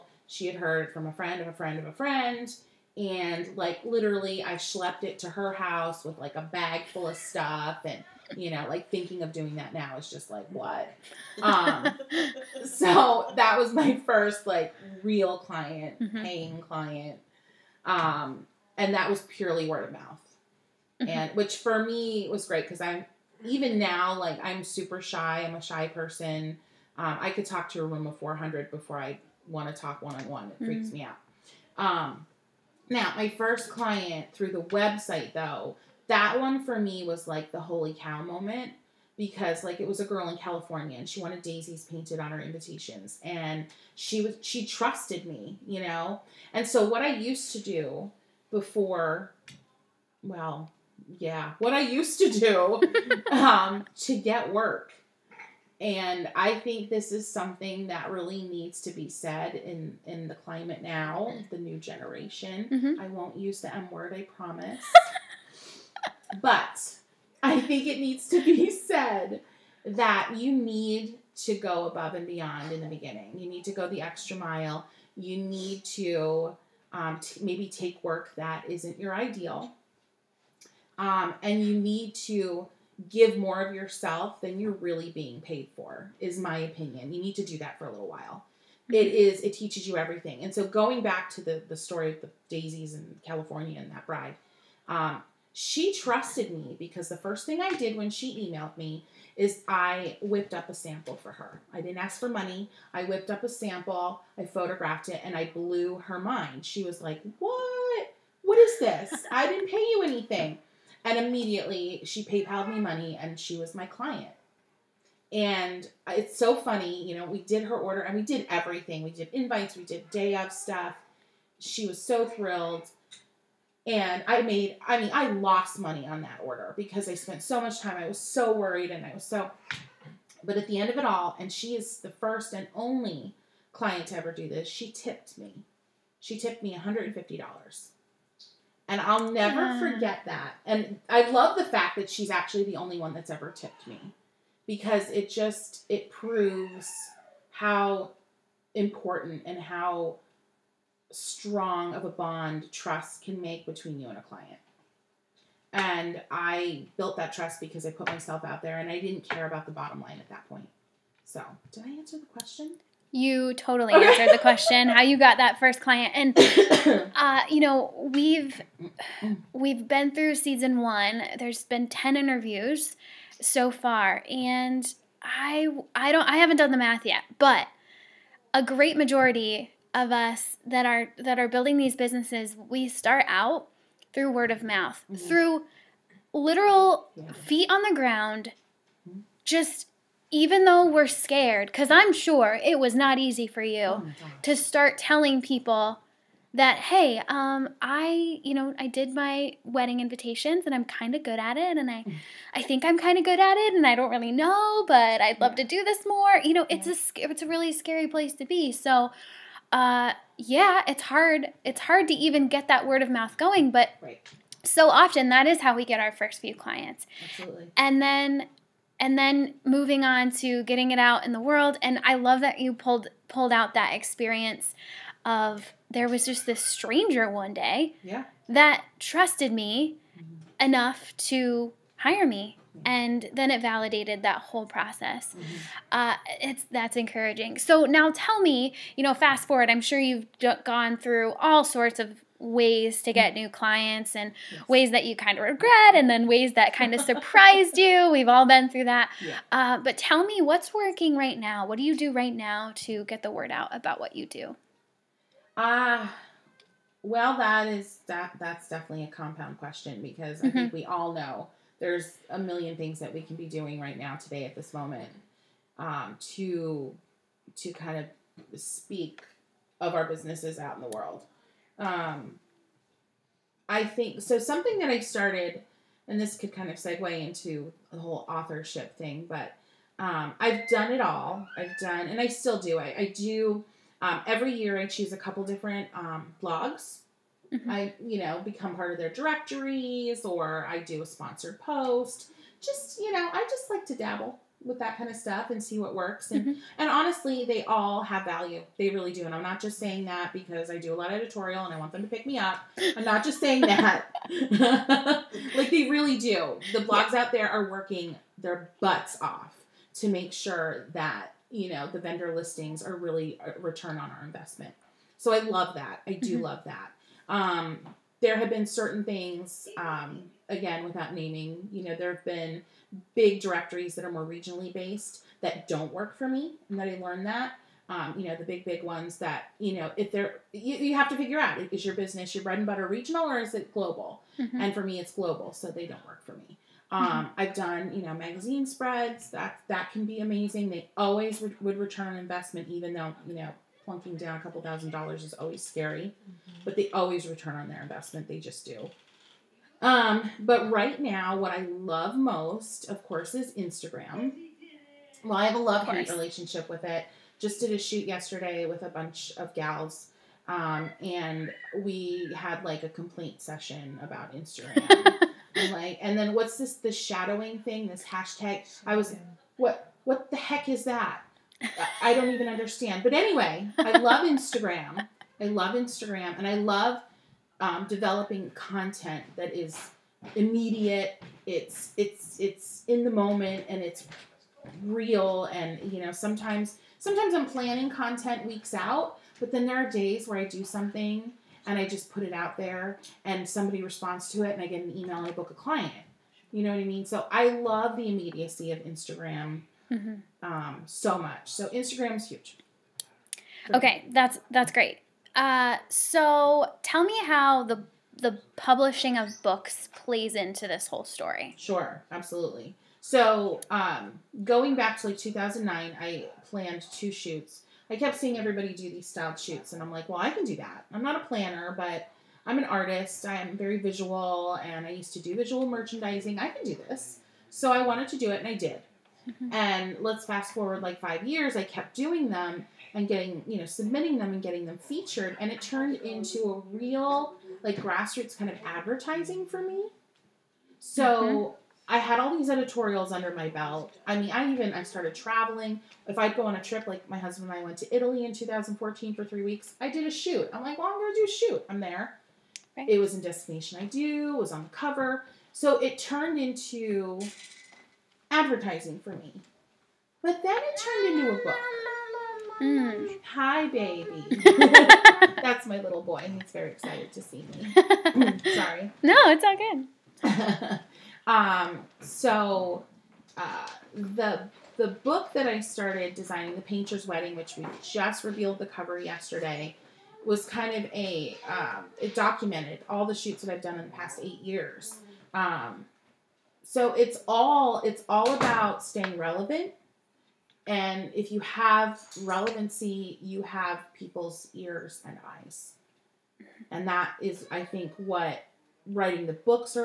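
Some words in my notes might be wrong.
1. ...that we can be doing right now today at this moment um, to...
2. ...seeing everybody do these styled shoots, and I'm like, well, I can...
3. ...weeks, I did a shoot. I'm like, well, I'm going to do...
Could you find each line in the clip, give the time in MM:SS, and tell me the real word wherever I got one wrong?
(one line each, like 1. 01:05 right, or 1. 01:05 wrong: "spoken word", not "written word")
1. 04:23 right
2. 06:58 right
3. 07:29 right.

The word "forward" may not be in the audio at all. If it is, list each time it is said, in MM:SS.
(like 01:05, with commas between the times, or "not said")
03:59, 07:10.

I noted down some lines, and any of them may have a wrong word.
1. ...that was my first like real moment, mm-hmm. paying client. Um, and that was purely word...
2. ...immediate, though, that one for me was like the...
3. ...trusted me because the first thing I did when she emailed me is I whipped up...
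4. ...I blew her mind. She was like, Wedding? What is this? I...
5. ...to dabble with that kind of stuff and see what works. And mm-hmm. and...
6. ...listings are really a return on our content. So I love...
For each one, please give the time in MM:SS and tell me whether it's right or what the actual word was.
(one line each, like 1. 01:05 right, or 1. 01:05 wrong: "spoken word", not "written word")
1. 00:13 wrong: "client", not "moment"
2. 00:34 wrong: "website", not "immediate"
3. 01:35 right
4. 01:45 wrong: "What", not "Wedding"
5. 04:53 right
6. 05:12 wrong: "investment", not "content".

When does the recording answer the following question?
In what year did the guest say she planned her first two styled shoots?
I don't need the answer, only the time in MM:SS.
06:54.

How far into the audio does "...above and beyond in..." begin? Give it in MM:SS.
01:11.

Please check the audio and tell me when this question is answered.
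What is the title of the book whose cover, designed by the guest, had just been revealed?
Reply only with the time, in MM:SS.
07:56.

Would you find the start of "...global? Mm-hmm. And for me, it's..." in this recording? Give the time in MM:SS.
05:33.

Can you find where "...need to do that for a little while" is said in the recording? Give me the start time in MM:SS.
01:27.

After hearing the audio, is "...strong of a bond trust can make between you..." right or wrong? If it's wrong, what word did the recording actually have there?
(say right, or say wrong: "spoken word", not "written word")
right.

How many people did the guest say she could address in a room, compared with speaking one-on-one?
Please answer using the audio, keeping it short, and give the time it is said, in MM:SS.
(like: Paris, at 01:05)
400, at 00:27.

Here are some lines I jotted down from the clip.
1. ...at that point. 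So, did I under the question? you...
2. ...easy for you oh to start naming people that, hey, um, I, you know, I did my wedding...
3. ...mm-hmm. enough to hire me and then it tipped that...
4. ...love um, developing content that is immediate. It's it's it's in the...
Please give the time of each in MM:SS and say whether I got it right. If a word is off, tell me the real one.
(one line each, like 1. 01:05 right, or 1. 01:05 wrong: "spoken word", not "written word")
1. 02:40 wrong: "answer", not "under"
2. 03:13 wrong: "telling", not "naming"
3. 03:50 wrong: "validated", not "tipped"
4. 06:16 right.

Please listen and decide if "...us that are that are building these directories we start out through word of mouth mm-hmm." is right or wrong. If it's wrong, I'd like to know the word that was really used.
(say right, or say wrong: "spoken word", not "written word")
wrong: "businesses", not "directories".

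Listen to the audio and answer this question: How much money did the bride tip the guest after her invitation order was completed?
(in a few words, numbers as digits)
$150.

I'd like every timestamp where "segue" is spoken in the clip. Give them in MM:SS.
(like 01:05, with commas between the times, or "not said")
04:36.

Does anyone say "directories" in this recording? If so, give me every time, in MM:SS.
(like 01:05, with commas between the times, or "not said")
04:49, 05:23.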